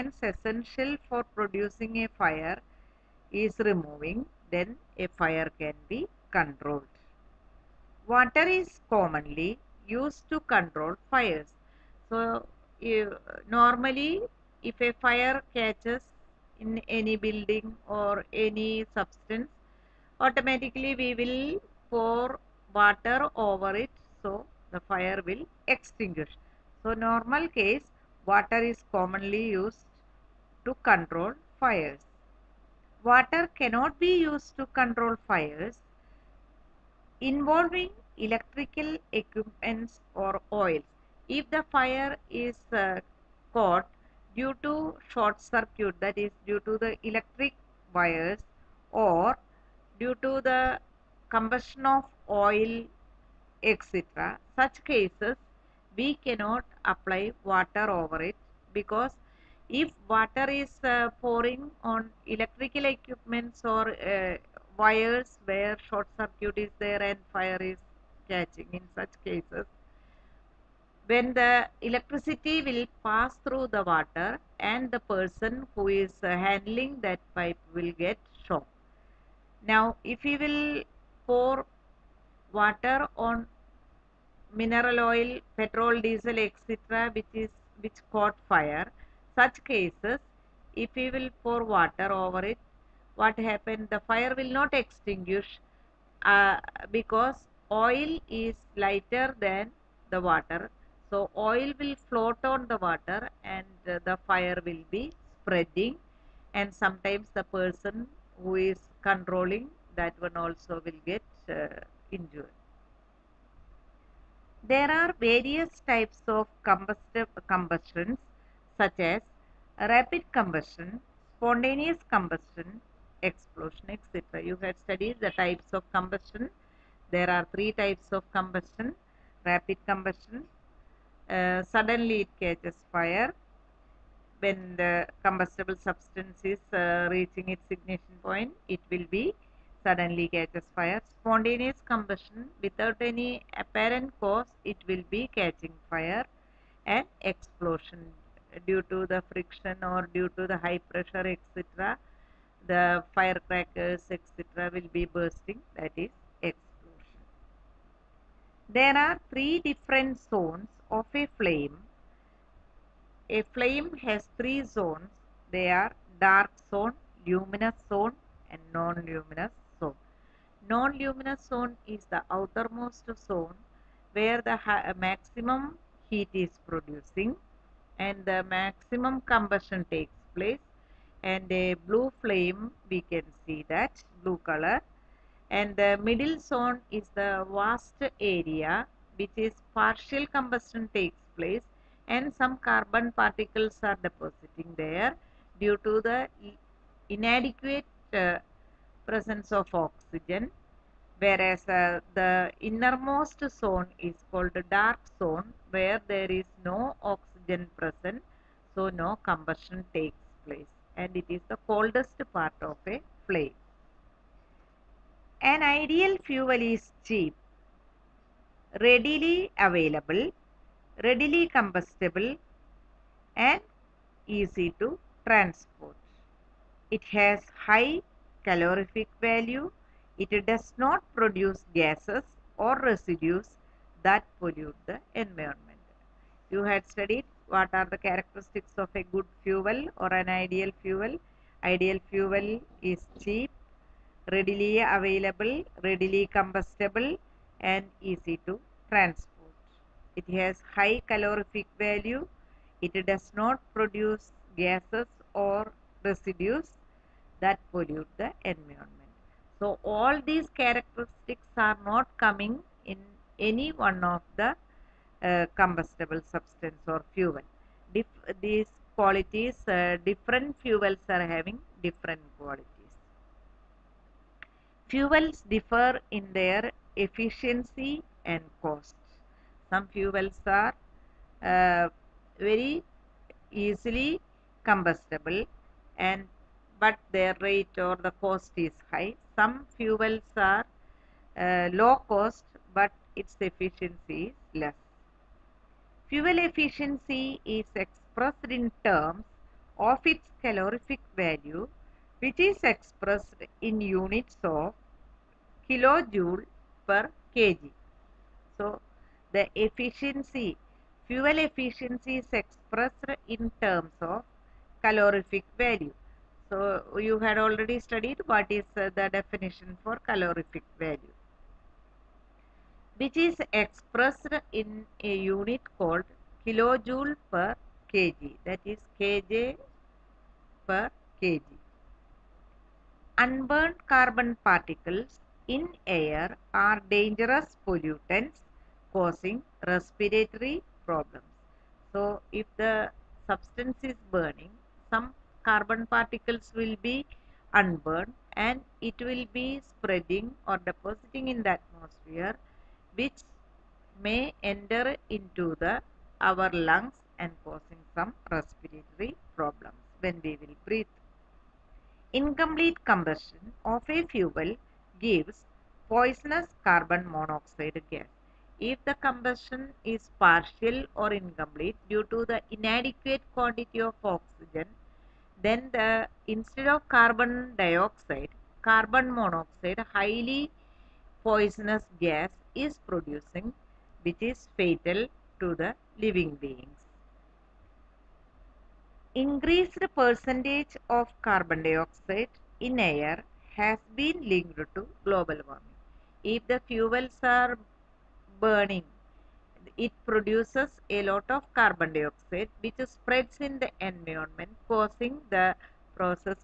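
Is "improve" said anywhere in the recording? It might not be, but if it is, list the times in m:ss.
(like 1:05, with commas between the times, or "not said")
not said.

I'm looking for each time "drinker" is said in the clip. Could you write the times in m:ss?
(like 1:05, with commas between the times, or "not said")
not said.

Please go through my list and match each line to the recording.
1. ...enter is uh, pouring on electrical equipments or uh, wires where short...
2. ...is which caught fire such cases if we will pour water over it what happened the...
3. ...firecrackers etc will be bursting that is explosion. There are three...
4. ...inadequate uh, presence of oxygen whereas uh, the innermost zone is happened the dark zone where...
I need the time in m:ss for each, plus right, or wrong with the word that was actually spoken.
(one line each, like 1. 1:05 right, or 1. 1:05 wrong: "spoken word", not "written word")
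1. 1:00 wrong: "water", not "enter"
2. 1:27 right
3. 2:33 right
4. 3:17 wrong: "called", not "happened".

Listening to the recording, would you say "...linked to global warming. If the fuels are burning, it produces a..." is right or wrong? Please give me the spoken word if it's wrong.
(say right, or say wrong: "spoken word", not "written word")
right.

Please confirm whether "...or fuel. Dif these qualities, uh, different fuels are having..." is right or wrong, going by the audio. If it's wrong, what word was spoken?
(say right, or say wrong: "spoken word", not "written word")
right.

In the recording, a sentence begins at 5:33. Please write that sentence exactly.
Unburned carbon particles in air are dangerous pollutants causing respiratory problems.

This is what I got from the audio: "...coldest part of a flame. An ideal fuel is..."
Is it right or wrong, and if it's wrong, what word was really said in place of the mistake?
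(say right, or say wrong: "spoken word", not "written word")
right.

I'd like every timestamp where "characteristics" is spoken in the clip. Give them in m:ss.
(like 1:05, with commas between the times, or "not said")
3:58, 4:20.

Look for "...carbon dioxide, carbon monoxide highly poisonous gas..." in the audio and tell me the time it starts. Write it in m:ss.
6:16.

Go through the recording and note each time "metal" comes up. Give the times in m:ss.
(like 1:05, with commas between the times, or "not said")
not said.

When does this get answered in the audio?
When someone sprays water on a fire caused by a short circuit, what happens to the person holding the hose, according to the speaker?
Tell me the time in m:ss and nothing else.
1:17.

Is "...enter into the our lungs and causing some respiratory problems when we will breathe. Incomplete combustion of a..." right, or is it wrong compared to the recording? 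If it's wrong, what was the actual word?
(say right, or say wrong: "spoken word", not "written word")
right.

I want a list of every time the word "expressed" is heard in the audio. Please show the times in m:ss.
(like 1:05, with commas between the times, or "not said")
4:57, 5:02, 5:12, 5:23.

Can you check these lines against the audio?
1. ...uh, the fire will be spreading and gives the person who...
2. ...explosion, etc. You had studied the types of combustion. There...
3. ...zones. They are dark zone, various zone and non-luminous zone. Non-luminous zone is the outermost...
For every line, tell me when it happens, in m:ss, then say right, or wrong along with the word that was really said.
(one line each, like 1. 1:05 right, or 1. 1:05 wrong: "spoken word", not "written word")
1. 1:43 wrong: "sometimes", not "gives"
2. 2:03 right
3. 2:44 wrong: "luminous", not "various".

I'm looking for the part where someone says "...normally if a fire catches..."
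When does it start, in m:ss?
0:13.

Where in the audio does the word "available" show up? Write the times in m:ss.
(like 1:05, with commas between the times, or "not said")
3:39, 4:04.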